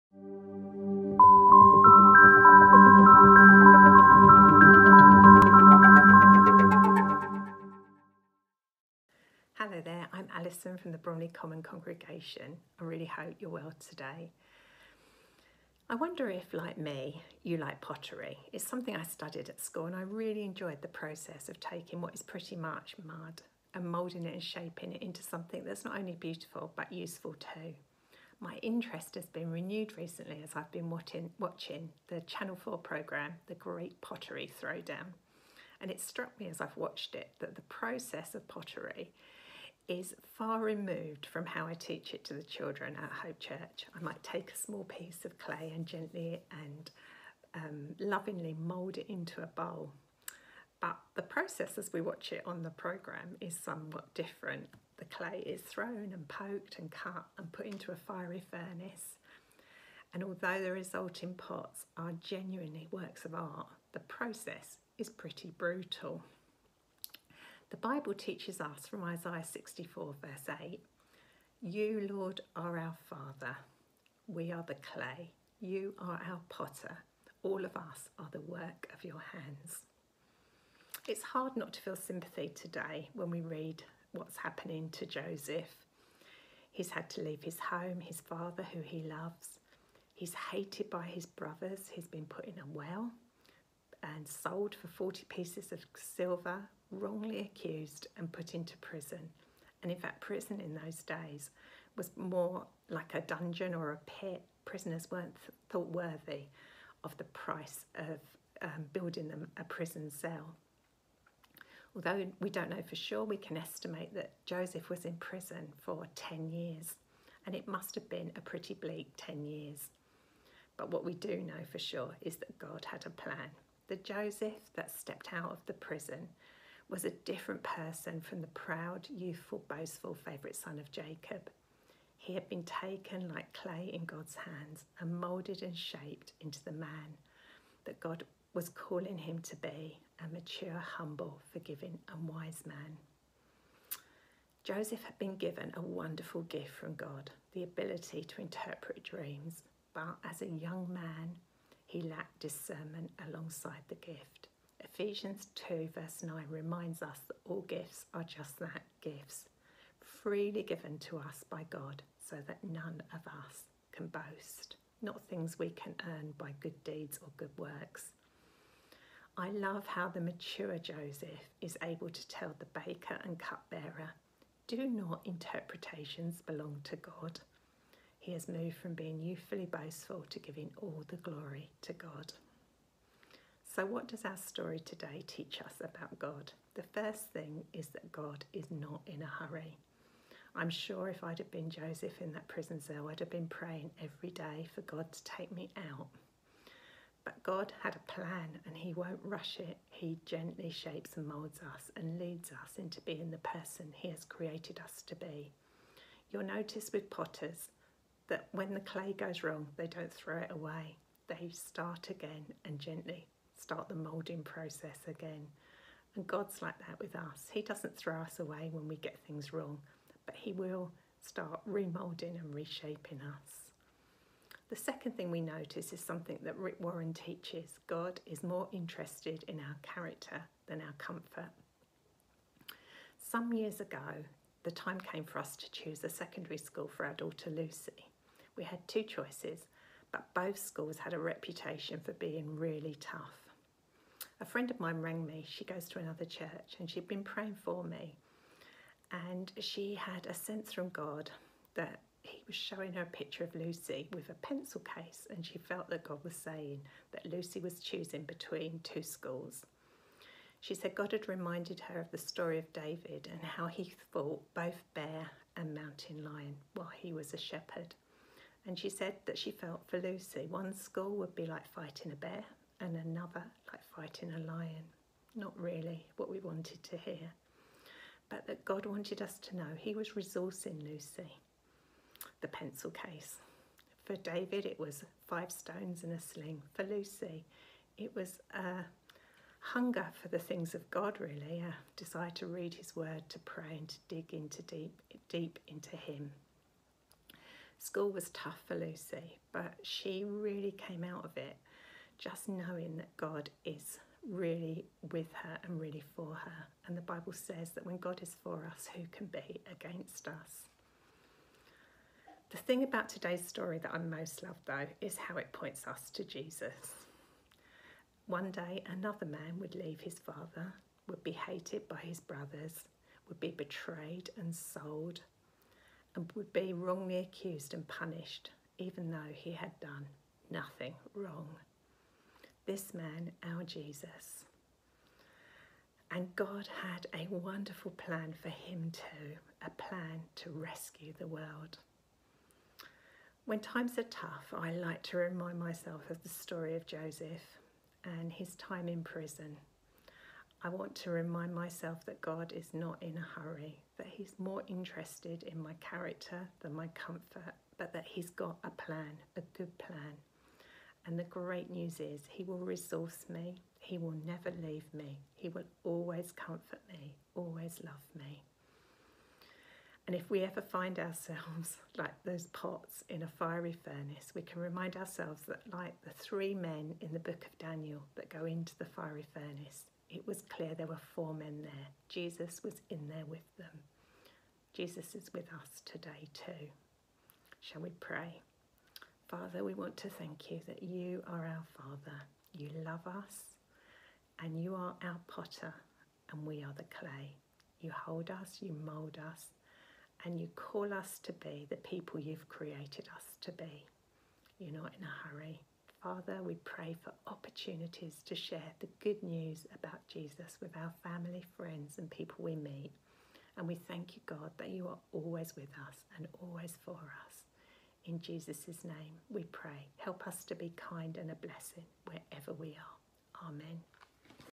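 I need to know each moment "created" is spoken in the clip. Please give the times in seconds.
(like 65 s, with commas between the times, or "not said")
204 s, 402 s.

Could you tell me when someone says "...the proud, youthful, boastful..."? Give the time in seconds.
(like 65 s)
128 s.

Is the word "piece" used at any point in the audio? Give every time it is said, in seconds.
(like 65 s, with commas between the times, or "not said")
44 s, 95 s.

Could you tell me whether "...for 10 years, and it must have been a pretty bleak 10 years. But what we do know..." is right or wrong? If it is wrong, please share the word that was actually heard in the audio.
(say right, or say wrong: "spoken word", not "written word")
right.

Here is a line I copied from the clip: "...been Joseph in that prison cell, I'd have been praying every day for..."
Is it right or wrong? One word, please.
right.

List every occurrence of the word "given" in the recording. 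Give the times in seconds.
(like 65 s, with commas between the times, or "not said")
145 s, 160 s.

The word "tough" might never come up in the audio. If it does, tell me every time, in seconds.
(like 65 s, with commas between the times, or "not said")
242 s, 298 s, 344 s.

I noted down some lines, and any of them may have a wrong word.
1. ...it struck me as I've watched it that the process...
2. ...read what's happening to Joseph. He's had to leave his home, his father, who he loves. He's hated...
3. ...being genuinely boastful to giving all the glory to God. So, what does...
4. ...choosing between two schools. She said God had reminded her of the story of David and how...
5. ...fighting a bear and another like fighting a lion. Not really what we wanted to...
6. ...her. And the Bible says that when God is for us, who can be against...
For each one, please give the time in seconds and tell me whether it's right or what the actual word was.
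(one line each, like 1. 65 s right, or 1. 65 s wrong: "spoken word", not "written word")
1. 35 s right
2. 83 s right
3. 178 s wrong: "youthfully", not "genuinely"
4. 257 s right
5. 271 s right
6. 306 s right.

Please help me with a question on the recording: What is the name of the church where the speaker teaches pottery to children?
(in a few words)
Hope Church.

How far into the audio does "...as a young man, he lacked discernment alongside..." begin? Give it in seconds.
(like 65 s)
150 s.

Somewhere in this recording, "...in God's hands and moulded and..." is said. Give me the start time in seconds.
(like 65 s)
133 s.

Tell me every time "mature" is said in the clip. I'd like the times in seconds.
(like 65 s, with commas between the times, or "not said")
140 s, 170 s.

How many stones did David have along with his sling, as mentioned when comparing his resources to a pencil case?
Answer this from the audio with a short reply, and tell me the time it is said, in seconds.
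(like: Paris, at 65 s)
5, at 285 s.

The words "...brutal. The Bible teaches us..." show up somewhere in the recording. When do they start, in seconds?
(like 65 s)
65 s.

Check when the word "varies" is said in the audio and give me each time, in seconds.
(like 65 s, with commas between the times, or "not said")
not said.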